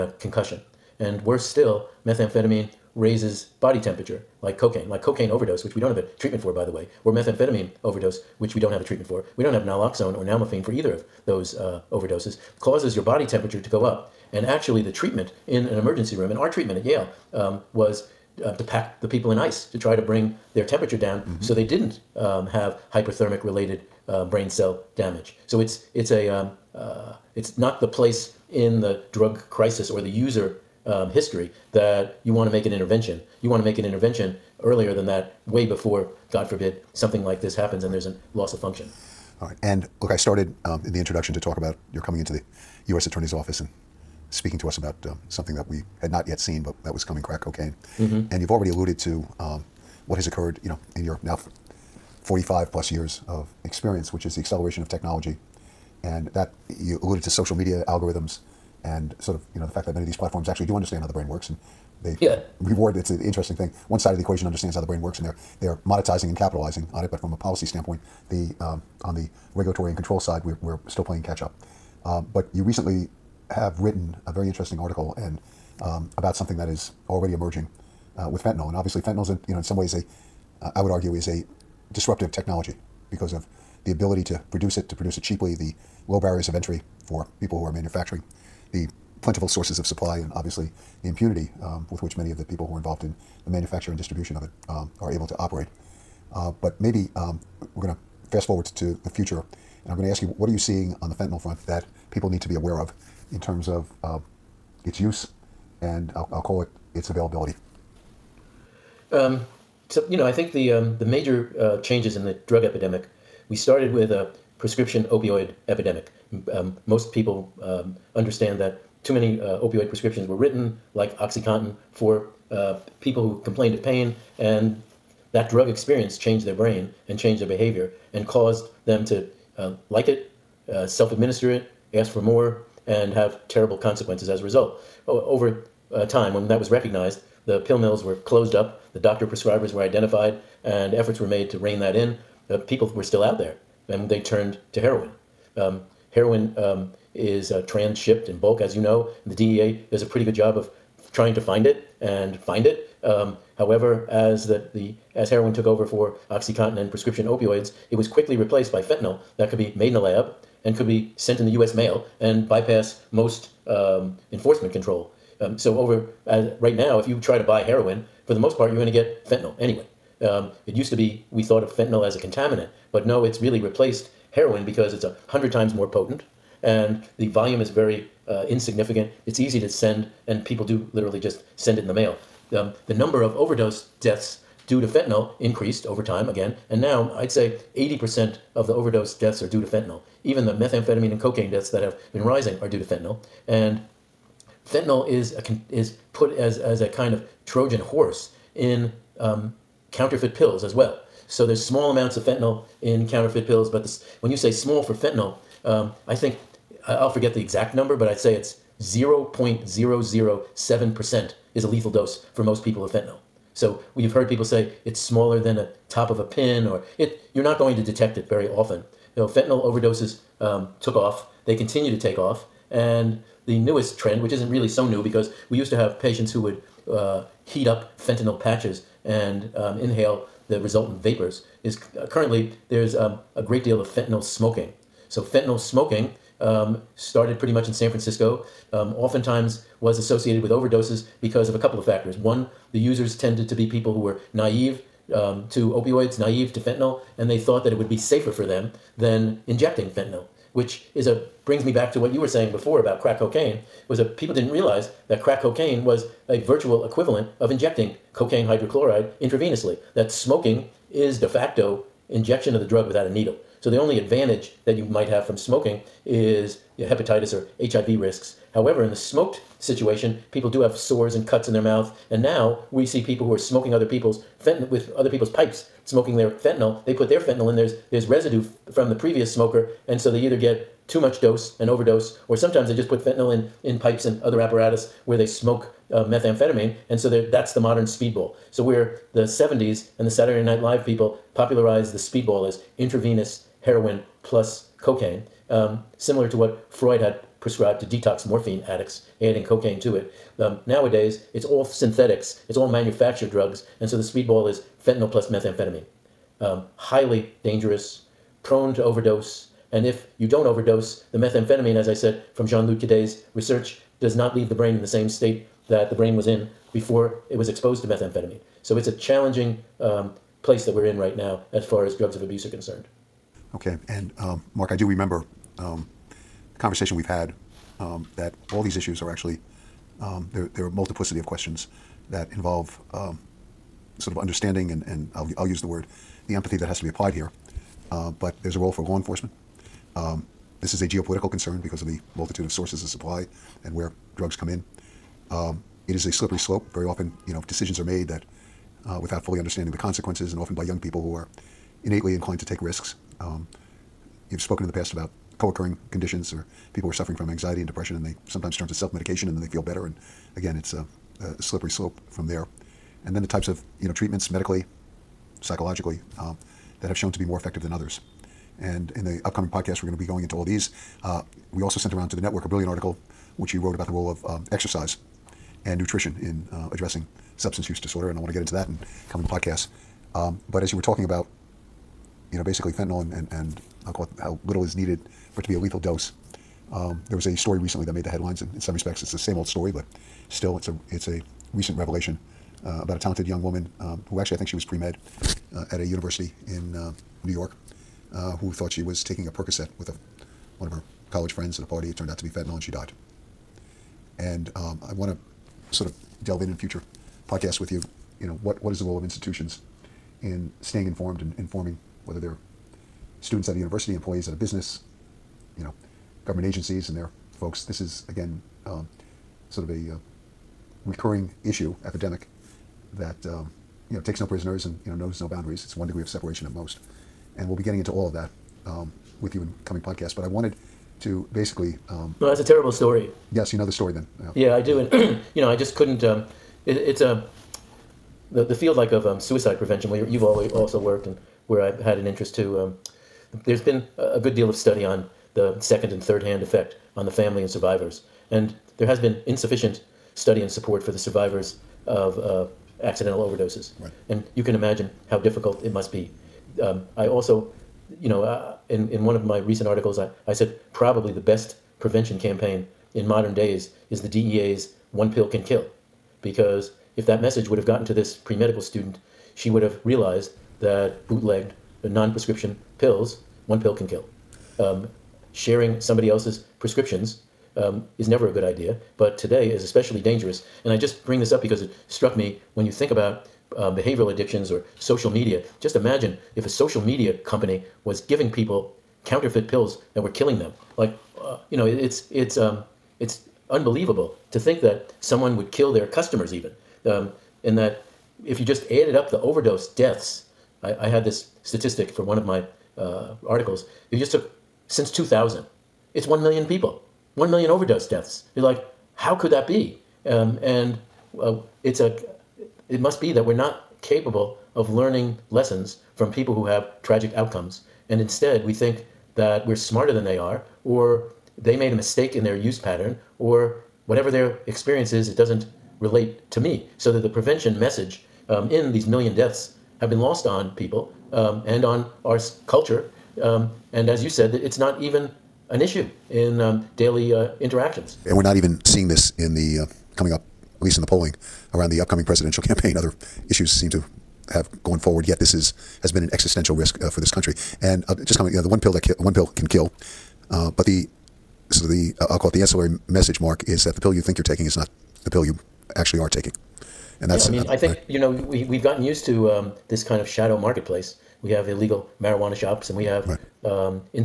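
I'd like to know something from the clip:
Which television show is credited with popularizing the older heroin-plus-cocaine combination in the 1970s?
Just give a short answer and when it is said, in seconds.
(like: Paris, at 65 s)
Saturday Night Live, at 290 s.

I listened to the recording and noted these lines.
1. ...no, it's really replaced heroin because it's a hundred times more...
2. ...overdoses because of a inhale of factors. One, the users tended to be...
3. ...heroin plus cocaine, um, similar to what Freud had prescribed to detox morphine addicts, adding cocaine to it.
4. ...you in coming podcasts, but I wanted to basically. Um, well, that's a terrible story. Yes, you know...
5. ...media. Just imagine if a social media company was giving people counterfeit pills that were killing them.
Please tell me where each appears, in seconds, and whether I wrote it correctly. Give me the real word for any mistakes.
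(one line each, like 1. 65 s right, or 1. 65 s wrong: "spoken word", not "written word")
1. 173 s right
2. 240 s wrong: "couple", not "inhale"
3. 293 s right
4. 429 s right
5. 485 s right.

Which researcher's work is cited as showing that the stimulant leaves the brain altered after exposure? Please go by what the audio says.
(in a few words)
Jean Lud Cadet.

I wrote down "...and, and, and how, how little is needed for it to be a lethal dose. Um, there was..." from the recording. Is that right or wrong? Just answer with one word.
right.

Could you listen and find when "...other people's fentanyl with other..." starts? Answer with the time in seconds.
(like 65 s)
273 s.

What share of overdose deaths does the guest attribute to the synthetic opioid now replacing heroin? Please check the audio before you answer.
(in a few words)
80%.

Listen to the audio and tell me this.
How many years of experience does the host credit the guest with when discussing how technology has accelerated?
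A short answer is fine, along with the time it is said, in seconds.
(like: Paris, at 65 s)
45 plus, at 52 s.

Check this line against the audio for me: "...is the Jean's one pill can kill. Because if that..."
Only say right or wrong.
wrong.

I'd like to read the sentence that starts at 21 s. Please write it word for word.
so they didn't um, have hyperthermic related uh, brain cell damage.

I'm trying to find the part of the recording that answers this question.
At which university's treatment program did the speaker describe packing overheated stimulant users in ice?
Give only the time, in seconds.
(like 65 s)
16 s.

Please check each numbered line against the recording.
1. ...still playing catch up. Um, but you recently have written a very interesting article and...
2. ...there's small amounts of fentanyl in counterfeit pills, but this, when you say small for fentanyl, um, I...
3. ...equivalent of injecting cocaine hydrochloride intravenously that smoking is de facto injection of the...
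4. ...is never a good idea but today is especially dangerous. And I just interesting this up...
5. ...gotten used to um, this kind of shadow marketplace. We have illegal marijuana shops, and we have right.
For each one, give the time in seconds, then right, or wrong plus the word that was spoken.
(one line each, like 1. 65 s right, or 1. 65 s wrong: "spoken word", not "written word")
1. 70 s right
2. 201 s right
3. 256 s right
4. 477 s wrong: "bring", not "interesting"
5. 558 s right.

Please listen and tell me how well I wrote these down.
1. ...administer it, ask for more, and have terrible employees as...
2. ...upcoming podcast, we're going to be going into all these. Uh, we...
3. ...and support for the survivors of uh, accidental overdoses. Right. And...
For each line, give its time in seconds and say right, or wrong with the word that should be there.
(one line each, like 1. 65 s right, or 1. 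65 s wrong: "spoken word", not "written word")
1. 131 s wrong: "consequences", not "employees"
2. 369 s right
3. 450 s right.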